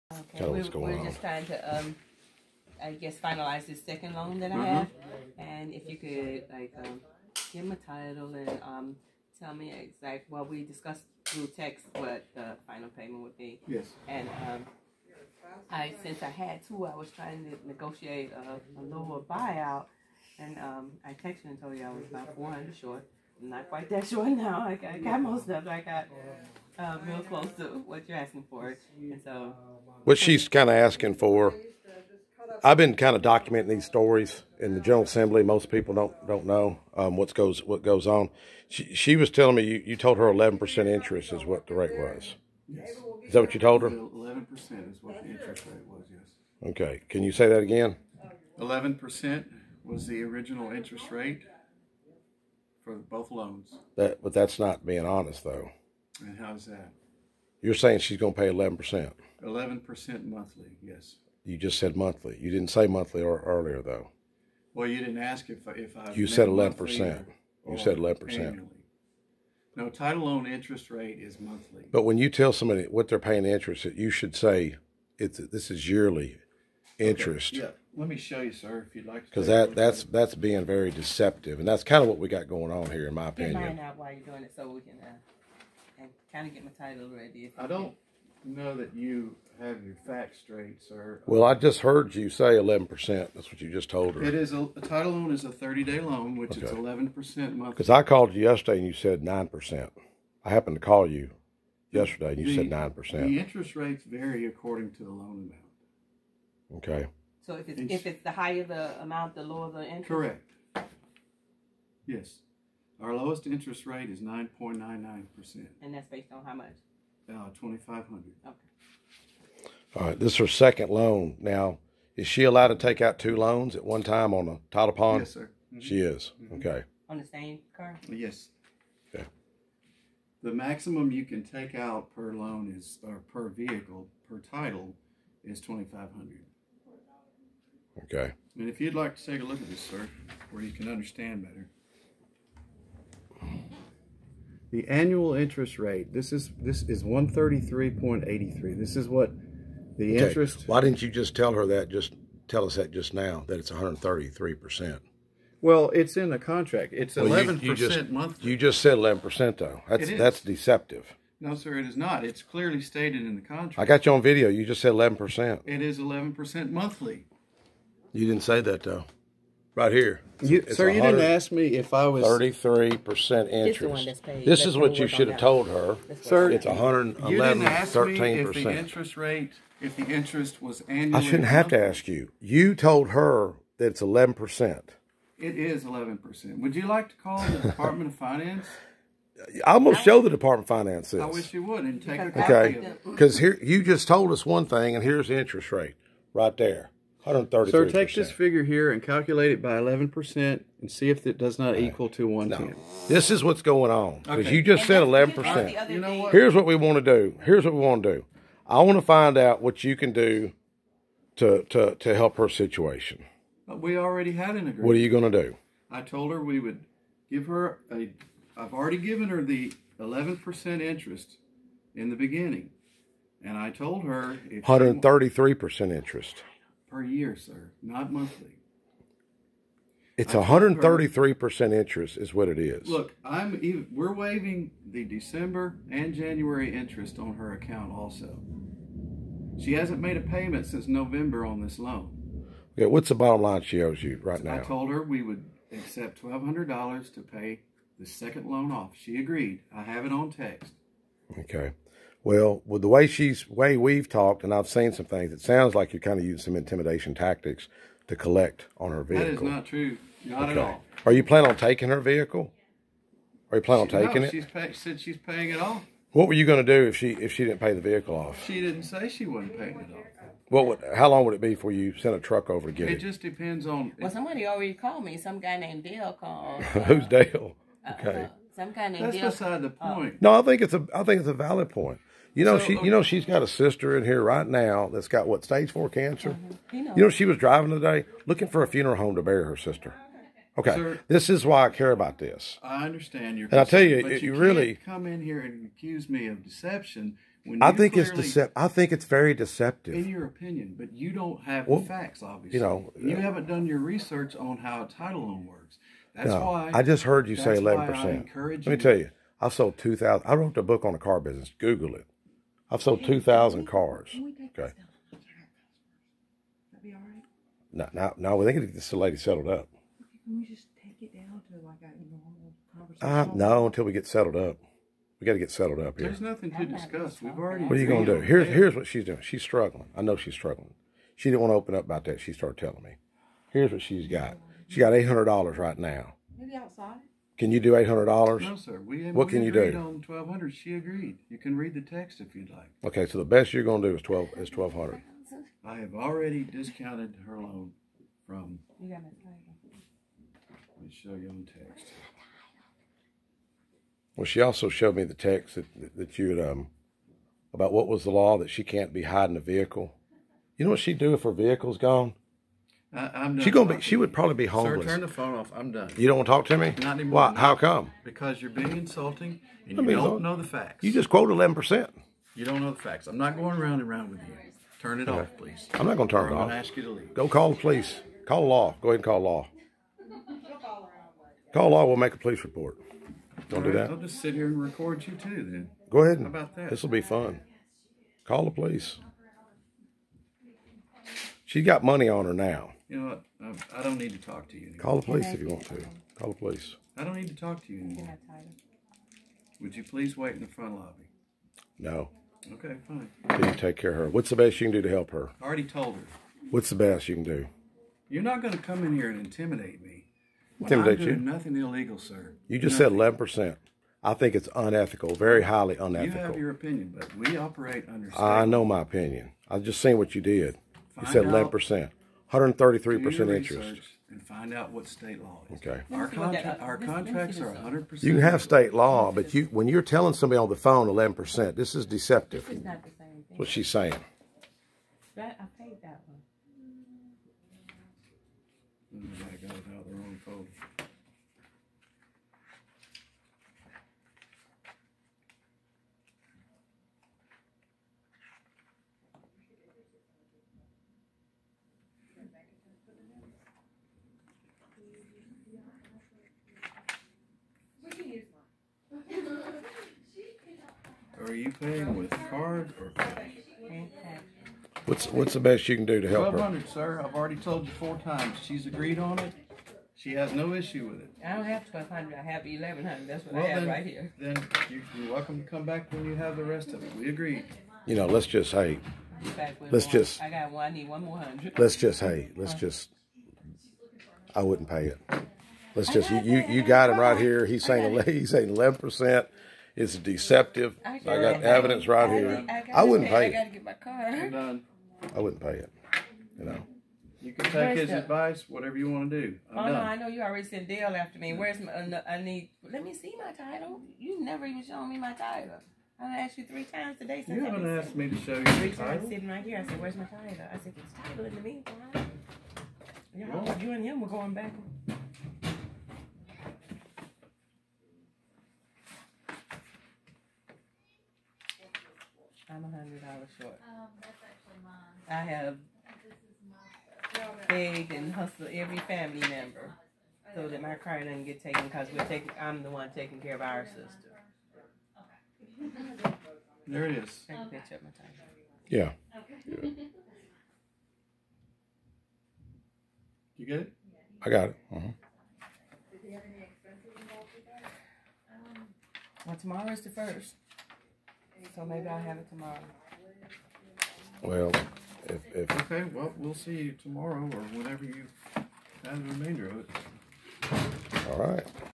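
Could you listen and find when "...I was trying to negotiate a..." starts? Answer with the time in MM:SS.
00:16.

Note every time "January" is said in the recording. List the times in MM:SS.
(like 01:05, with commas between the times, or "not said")
03:56.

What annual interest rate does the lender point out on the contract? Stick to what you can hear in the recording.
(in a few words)
133.83.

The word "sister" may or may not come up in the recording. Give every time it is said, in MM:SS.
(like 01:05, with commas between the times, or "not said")
04:43, 04:49, 08:53.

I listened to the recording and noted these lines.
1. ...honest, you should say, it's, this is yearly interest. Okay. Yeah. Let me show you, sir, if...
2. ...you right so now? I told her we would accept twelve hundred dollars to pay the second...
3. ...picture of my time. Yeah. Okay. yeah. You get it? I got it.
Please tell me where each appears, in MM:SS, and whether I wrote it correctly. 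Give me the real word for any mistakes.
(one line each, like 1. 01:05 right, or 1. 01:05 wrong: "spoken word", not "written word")
1. 01:13 wrong: "interest", not "honest"
2. 04:04 right
3. 08:57 right.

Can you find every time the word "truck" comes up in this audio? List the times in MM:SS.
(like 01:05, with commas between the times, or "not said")
04:32.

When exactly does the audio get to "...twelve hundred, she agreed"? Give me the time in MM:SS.
05:40.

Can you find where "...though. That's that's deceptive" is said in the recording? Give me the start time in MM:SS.
02:39.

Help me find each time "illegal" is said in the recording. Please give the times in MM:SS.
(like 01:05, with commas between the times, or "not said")
06:51.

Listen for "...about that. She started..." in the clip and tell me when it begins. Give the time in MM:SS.
05:31.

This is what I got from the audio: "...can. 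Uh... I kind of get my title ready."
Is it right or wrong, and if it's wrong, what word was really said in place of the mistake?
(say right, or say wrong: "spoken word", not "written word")
right.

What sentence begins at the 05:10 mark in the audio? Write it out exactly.
I wrote a book on the car business.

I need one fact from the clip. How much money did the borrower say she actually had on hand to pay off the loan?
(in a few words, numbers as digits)
$1100.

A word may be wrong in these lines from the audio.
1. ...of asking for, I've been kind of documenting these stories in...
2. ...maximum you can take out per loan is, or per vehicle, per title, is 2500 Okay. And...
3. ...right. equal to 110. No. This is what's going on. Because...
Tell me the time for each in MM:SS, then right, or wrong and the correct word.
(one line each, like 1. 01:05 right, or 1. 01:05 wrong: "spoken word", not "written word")
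1. 00:30 right
2. 02:10 right
3. 03:21 right.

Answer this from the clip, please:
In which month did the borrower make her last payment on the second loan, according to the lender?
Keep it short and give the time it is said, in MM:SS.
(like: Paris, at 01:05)
November, at 04:00.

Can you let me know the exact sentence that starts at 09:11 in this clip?
So maybe I'll have it tomorrow.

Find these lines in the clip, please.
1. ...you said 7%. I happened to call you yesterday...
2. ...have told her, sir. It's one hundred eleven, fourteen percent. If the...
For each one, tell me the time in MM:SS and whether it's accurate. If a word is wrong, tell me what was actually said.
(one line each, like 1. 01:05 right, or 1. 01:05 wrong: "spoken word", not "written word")
1. 01:38 wrong: "9", not "7"
2. 02:55 wrong: "thirteen", not "fourteen".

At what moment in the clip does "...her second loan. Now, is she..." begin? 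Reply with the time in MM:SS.
02:00.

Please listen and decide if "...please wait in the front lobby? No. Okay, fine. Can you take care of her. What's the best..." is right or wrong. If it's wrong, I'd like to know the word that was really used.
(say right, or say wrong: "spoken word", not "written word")
right.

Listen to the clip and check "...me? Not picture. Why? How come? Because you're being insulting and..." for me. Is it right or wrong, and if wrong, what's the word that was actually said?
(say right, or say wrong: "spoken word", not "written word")
wrong: "anymore", not "picture".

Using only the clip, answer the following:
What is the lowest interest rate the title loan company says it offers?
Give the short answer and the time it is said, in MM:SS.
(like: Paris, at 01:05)
9.99%, at 01:54.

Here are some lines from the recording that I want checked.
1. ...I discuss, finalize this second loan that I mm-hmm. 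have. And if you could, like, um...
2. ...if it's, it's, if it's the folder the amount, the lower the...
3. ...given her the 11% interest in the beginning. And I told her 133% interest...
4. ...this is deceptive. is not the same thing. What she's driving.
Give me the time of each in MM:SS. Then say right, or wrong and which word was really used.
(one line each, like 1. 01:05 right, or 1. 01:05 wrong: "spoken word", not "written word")
1. 00:02 wrong: "guess", not "discuss"
2. 01:47 wrong: "higher", not "folder"
3. 03:38 right
4. 07:11 wrong: "saying", not "driving".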